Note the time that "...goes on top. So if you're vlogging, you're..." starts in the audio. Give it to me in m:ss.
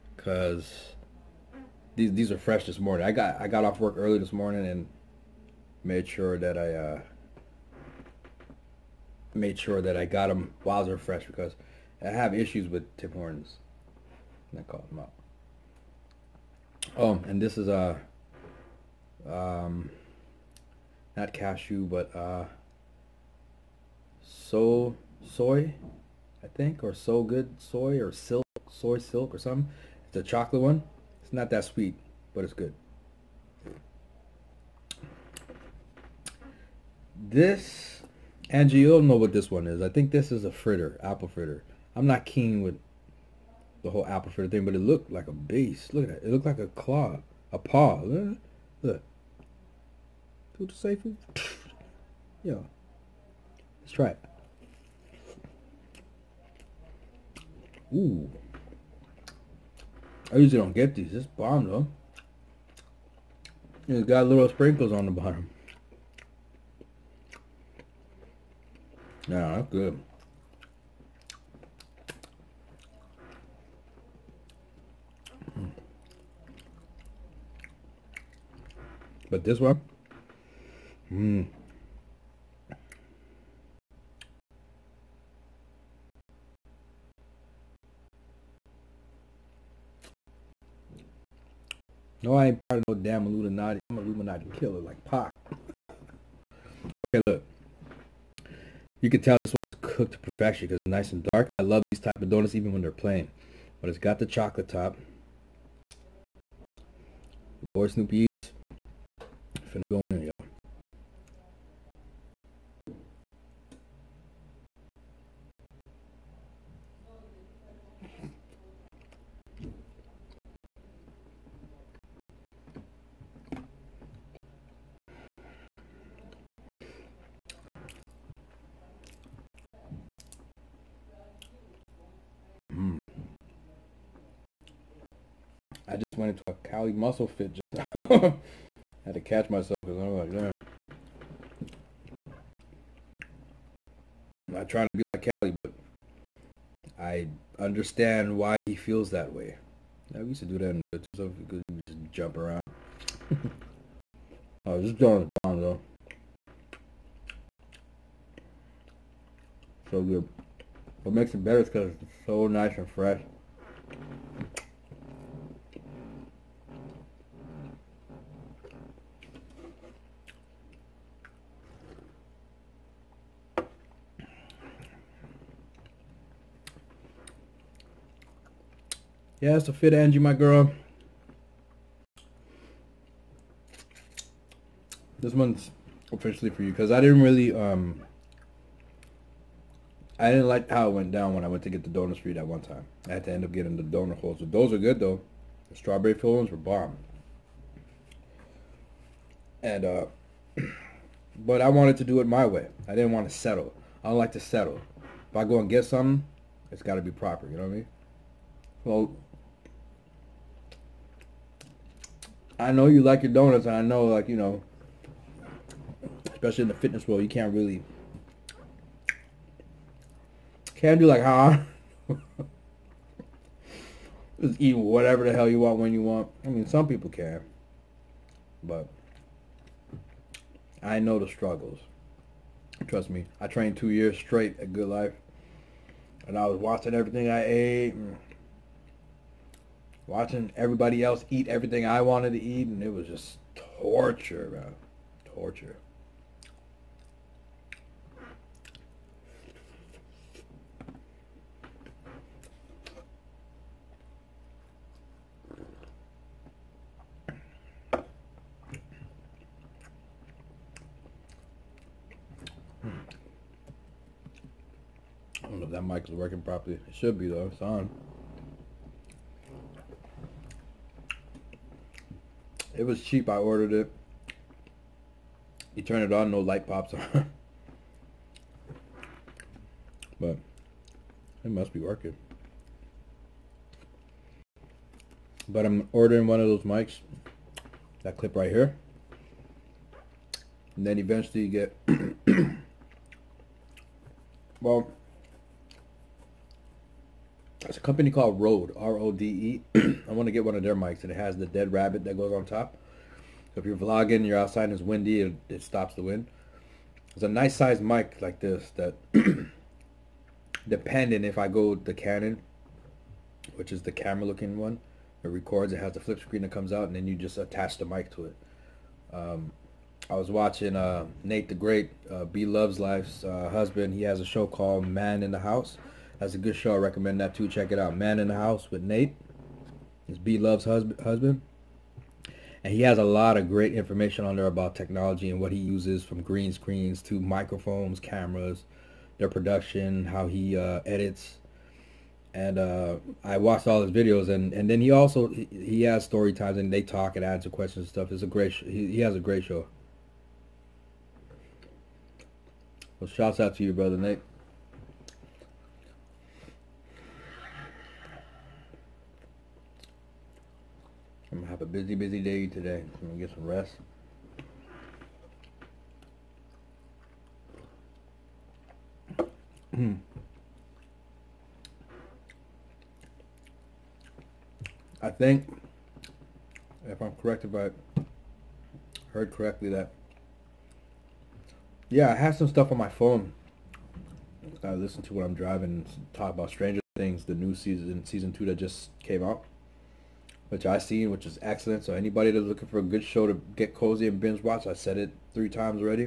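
5:02.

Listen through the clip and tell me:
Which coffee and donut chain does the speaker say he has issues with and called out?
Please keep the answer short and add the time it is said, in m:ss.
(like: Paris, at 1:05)
Tim Hortons, at 0:12.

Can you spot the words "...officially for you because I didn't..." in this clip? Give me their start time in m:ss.
3:06.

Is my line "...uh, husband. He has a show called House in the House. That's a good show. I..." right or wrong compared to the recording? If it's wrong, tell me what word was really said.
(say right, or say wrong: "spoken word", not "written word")
wrong: "Man", not "House".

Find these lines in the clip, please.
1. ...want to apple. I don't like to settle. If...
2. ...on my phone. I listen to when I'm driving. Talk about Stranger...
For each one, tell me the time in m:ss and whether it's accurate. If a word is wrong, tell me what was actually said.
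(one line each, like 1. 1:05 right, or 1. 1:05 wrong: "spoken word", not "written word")
1. 3:23 wrong: "settle", not "apple"
2. 6:22 right.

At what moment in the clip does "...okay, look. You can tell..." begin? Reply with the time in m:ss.
1:37.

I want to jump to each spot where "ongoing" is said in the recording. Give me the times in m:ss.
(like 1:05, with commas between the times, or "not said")
not said.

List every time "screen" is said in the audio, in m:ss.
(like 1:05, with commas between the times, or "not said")
5:16, 5:36.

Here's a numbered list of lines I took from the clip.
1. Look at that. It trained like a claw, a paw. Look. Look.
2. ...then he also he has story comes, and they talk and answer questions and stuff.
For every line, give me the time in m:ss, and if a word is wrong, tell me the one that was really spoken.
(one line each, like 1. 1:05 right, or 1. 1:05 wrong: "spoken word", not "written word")
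1. 0:45 wrong: "looked", not "trained"
2. 5:44 wrong: "times", not "comes".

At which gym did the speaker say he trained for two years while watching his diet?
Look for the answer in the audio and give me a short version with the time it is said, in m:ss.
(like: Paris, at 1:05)
GoodLife, at 3:54.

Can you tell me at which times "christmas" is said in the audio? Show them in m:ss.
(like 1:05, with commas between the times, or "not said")
not said.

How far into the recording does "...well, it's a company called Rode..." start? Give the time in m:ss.
4:54.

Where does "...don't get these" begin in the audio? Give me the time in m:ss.
1:00.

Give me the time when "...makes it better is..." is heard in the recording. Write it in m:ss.
2:41.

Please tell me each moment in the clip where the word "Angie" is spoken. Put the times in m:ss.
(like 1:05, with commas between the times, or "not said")
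0:38, 2:59.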